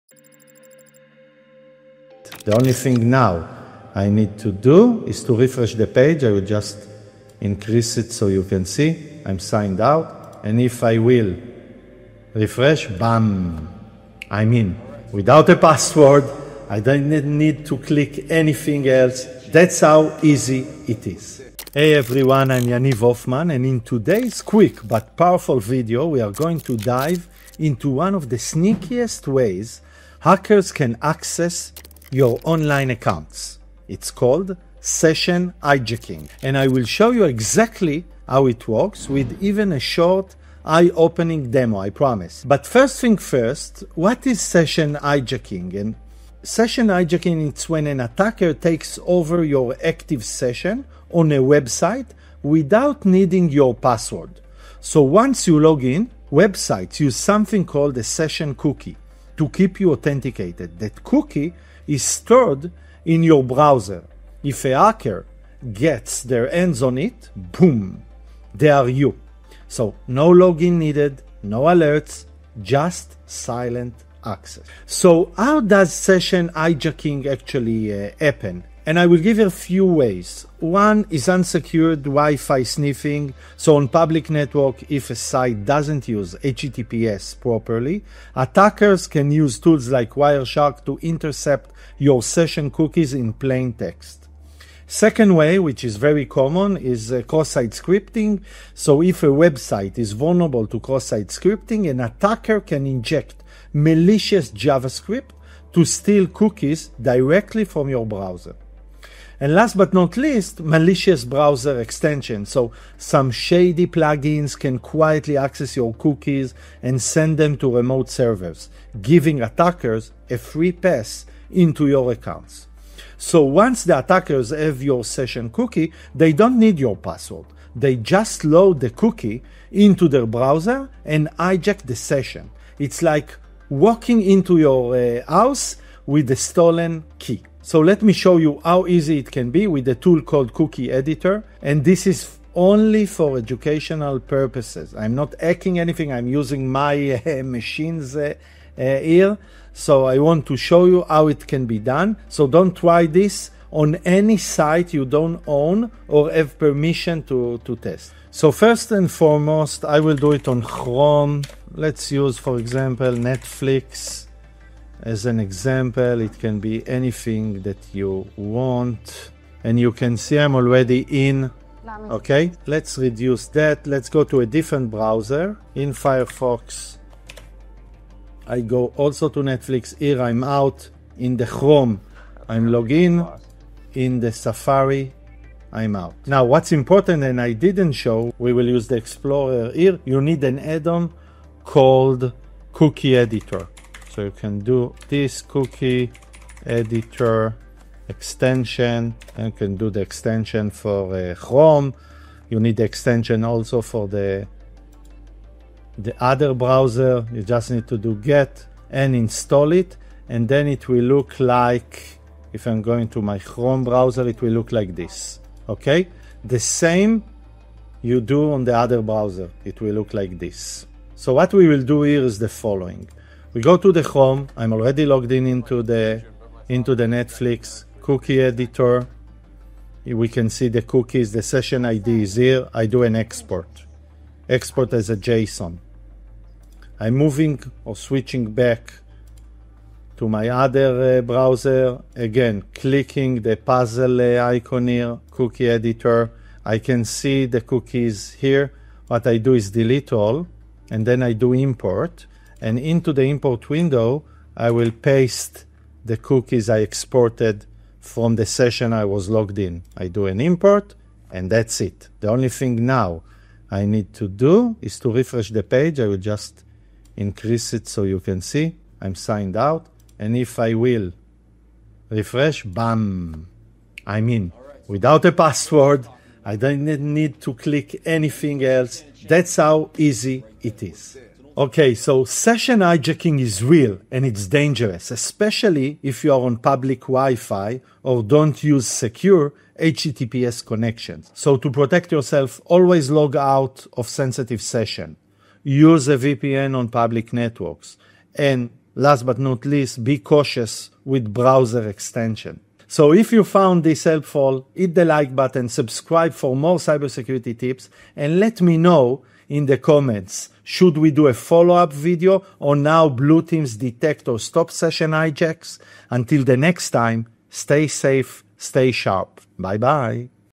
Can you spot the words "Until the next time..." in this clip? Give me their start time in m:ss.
5:16.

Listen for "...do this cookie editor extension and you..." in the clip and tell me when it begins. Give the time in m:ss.
3:14.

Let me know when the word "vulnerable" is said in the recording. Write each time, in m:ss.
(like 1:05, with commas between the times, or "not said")
1:40.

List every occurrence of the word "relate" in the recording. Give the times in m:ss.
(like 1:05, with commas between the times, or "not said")
not said.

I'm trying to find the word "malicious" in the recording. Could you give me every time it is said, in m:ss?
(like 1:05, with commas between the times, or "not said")
1:43, 1:50.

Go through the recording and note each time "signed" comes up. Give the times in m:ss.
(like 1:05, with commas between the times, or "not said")
0:09, 4:29.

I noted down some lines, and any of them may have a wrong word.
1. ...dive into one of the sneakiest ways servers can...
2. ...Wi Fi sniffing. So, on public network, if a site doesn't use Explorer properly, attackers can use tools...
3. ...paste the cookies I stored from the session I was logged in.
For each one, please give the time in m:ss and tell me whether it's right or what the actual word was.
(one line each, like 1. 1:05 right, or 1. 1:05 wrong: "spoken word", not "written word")
1. 0:26 wrong: "hackers", not "servers"
2. 1:22 wrong: "HTTPS", not "Explorer"
3. 4:14 wrong: "exported", not "stored".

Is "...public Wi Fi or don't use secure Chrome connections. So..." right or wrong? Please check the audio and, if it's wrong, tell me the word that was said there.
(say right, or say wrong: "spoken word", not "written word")
wrong: "HTTPS", not "Chrome".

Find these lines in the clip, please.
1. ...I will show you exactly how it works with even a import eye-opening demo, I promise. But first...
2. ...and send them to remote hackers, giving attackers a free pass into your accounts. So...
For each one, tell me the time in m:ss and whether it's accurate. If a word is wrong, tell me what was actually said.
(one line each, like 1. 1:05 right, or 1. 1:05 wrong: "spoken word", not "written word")
1. 0:36 wrong: "short", not "import"
2. 1:56 wrong: "servers", not "hackers".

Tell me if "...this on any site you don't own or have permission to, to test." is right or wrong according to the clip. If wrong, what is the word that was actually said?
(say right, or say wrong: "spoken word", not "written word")
right.